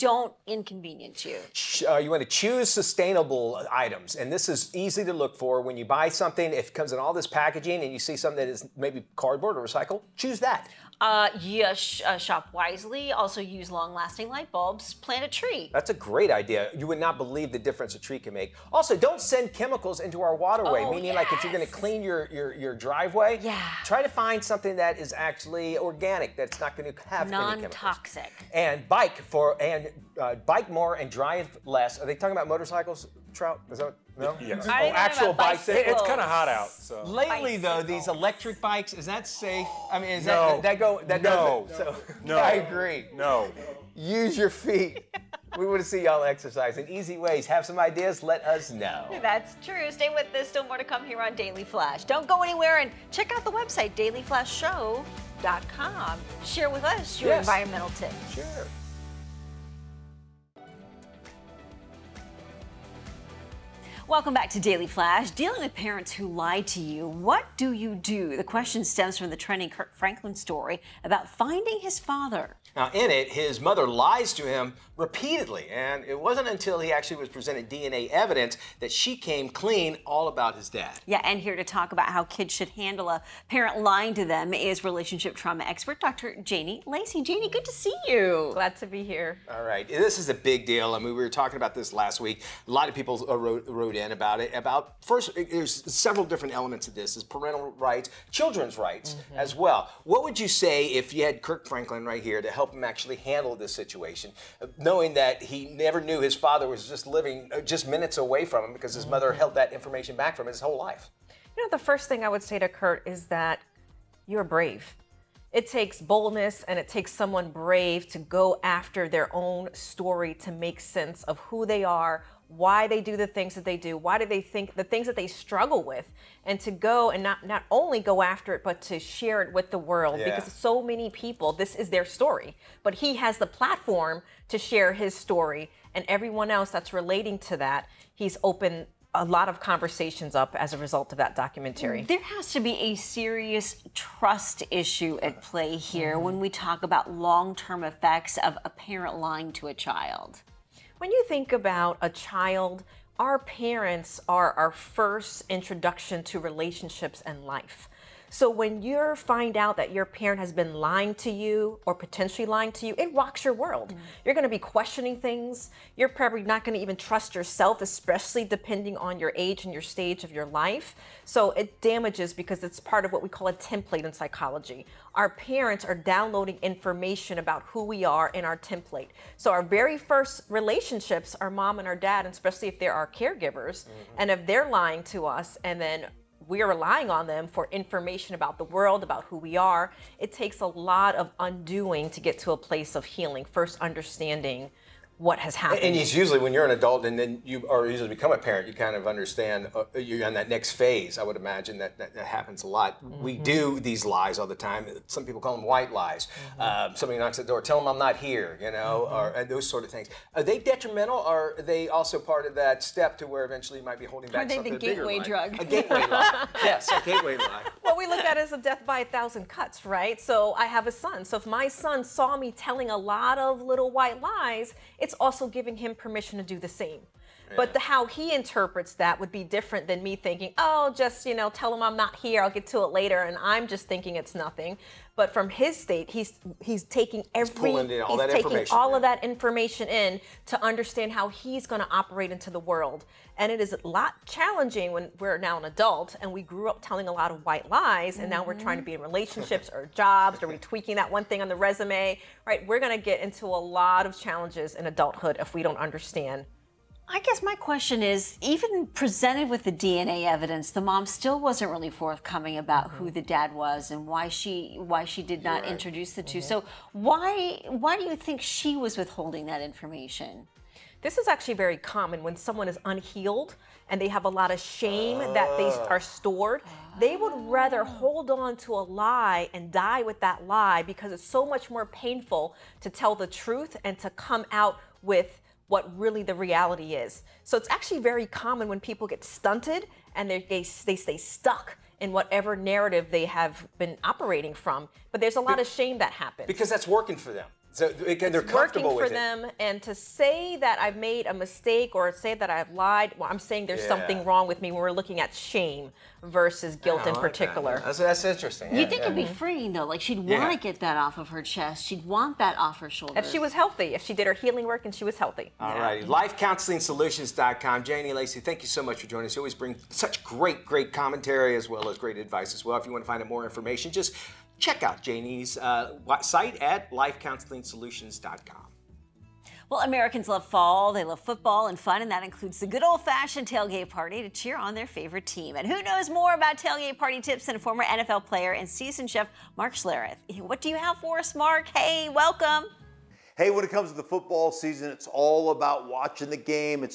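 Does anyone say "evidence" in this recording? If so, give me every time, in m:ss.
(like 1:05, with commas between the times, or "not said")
1:18, 4:20.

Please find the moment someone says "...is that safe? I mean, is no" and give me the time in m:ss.
0:38.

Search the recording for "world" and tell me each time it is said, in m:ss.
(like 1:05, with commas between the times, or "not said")
2:09, 2:43, 3:08, 4:02.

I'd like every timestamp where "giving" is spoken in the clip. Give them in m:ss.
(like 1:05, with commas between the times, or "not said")
3:45.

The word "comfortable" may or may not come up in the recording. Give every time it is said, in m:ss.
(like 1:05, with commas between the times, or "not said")
4:58.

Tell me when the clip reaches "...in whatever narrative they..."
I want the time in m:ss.
4:52.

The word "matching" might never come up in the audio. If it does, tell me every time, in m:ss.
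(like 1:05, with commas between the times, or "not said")
not said.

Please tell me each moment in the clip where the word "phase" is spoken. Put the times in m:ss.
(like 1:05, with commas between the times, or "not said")
3:20.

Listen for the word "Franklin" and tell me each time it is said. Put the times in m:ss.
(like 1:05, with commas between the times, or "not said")
1:09, 1:41.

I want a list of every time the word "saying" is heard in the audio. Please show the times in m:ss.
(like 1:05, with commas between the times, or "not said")
5:03.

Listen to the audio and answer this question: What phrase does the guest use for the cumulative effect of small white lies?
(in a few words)
Death by a thousand cuts.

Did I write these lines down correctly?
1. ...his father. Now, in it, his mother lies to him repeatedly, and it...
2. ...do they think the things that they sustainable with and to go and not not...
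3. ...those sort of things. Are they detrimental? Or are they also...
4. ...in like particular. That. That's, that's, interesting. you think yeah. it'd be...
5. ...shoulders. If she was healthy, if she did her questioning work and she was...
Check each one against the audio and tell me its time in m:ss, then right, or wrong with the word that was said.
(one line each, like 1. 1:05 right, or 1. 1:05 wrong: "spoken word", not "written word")
1. 1:11 right
2. 2:04 wrong: "struggle", not "sustainable"
3. 3:29 right
4. 5:07 right
5. 5:12 wrong: "healing", not "questioning".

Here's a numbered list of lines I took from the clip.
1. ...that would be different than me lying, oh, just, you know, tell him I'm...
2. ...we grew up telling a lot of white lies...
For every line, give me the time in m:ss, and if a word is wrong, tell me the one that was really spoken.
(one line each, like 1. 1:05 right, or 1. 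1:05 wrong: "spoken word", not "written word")
1. 3:48 wrong: "thinking", not "lying"
2. 4:06 right.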